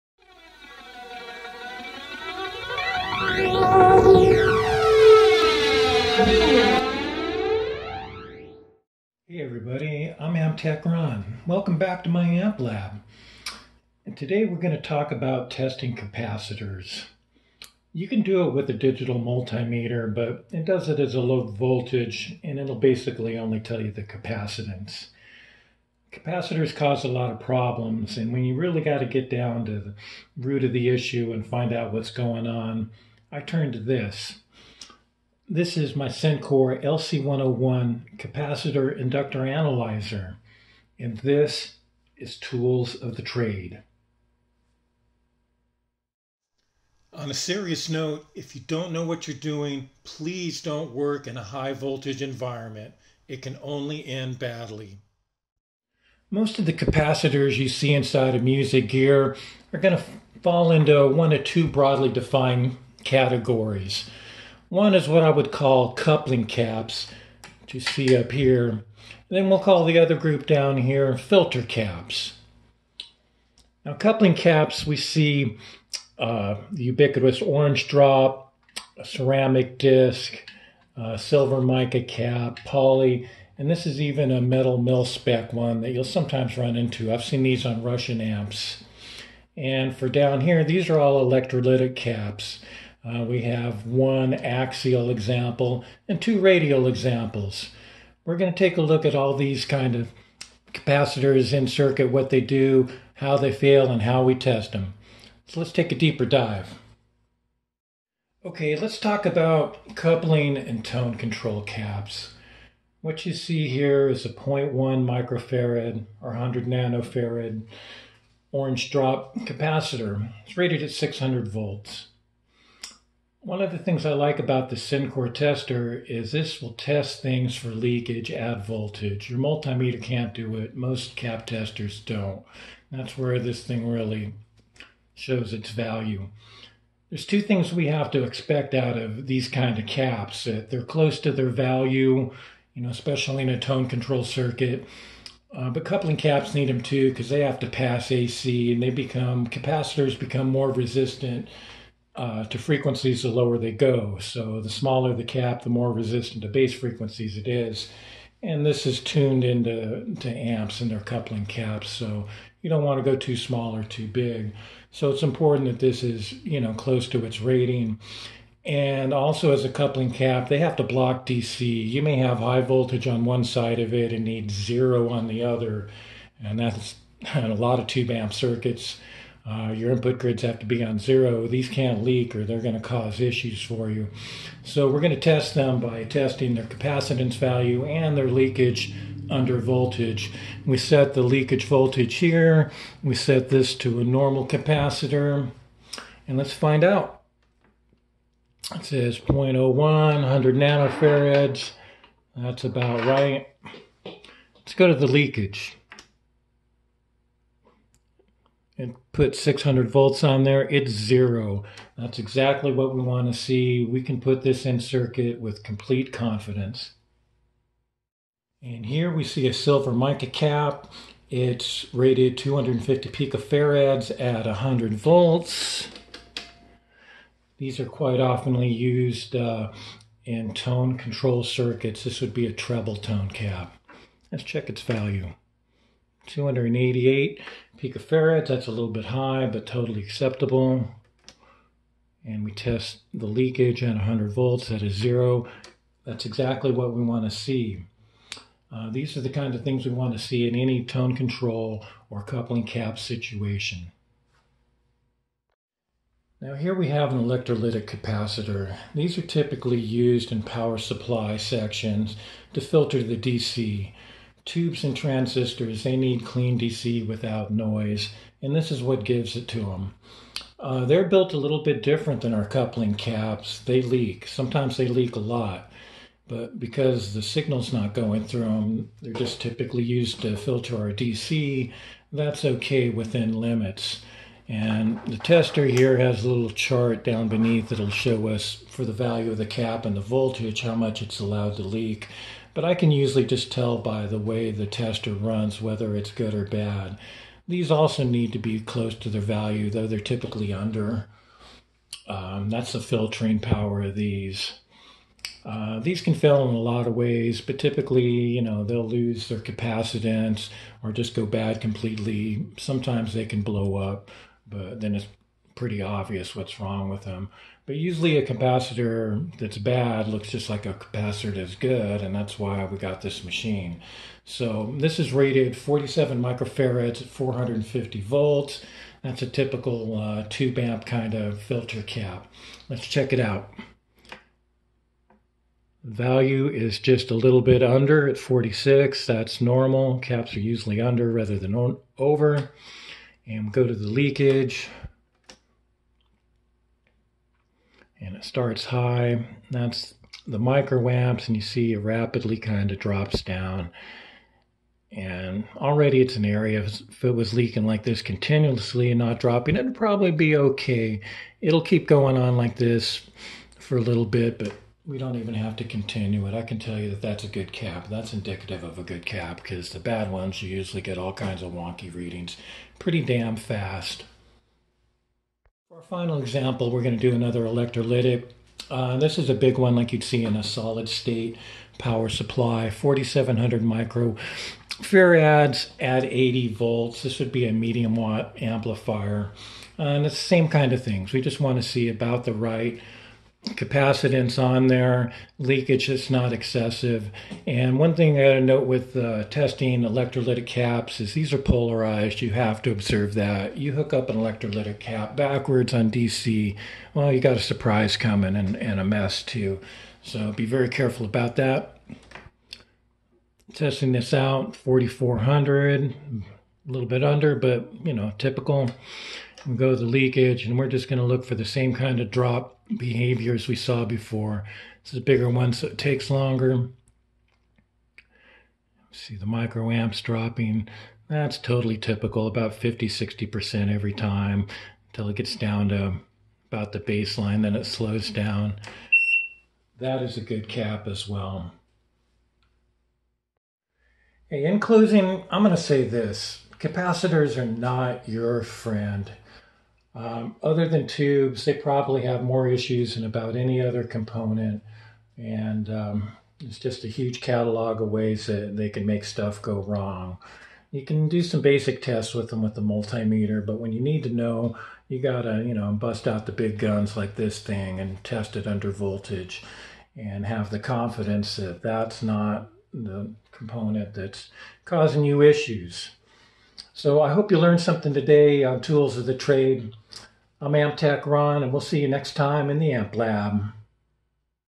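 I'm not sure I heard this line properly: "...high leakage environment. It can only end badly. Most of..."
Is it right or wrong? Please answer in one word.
wrong.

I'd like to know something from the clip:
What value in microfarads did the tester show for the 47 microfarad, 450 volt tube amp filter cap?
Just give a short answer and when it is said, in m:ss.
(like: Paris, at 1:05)
46, at 5:38.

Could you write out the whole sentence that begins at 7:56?
So I hope you learned something today on tools of the trade.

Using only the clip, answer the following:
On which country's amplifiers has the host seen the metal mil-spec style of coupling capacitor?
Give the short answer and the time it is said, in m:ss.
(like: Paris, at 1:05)
Russian, at 1:27.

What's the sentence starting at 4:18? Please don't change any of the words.
These are typically used in power supply sections to filter the DC.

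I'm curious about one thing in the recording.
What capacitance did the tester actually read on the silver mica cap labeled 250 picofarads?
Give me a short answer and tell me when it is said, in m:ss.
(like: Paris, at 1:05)
288 picofarads, at 3:56.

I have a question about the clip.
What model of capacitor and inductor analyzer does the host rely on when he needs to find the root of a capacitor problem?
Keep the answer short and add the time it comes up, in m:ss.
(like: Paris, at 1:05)
Sencore LC101, at 0:36.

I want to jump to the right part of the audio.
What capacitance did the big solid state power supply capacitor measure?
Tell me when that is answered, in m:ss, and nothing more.
6:54.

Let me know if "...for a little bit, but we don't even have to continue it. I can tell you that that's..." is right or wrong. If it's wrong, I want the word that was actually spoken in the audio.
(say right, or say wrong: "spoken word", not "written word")
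right.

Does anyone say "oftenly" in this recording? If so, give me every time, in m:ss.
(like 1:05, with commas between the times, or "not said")
3:48.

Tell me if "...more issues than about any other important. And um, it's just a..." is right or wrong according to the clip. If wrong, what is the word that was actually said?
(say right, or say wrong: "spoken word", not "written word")
wrong: "component", not "important".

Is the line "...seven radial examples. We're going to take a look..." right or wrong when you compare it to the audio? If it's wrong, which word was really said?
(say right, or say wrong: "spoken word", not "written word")
wrong: "two", not "seven".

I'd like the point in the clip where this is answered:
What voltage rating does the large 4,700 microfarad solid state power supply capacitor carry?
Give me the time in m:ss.
6:26.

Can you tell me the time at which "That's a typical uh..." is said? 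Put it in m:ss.
5:29.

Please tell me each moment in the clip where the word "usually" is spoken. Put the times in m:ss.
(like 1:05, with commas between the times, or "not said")
4:52, 5:17, 5:40, 6:10.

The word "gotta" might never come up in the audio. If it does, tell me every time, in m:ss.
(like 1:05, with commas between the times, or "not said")
6:38, 7:44.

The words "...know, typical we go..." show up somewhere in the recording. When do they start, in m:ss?
6:57.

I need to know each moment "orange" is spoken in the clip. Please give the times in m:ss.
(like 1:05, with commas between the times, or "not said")
1:17, 1:58.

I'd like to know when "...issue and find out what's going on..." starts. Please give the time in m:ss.
0:30.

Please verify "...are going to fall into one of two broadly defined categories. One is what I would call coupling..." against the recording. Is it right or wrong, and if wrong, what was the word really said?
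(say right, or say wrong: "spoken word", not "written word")
right.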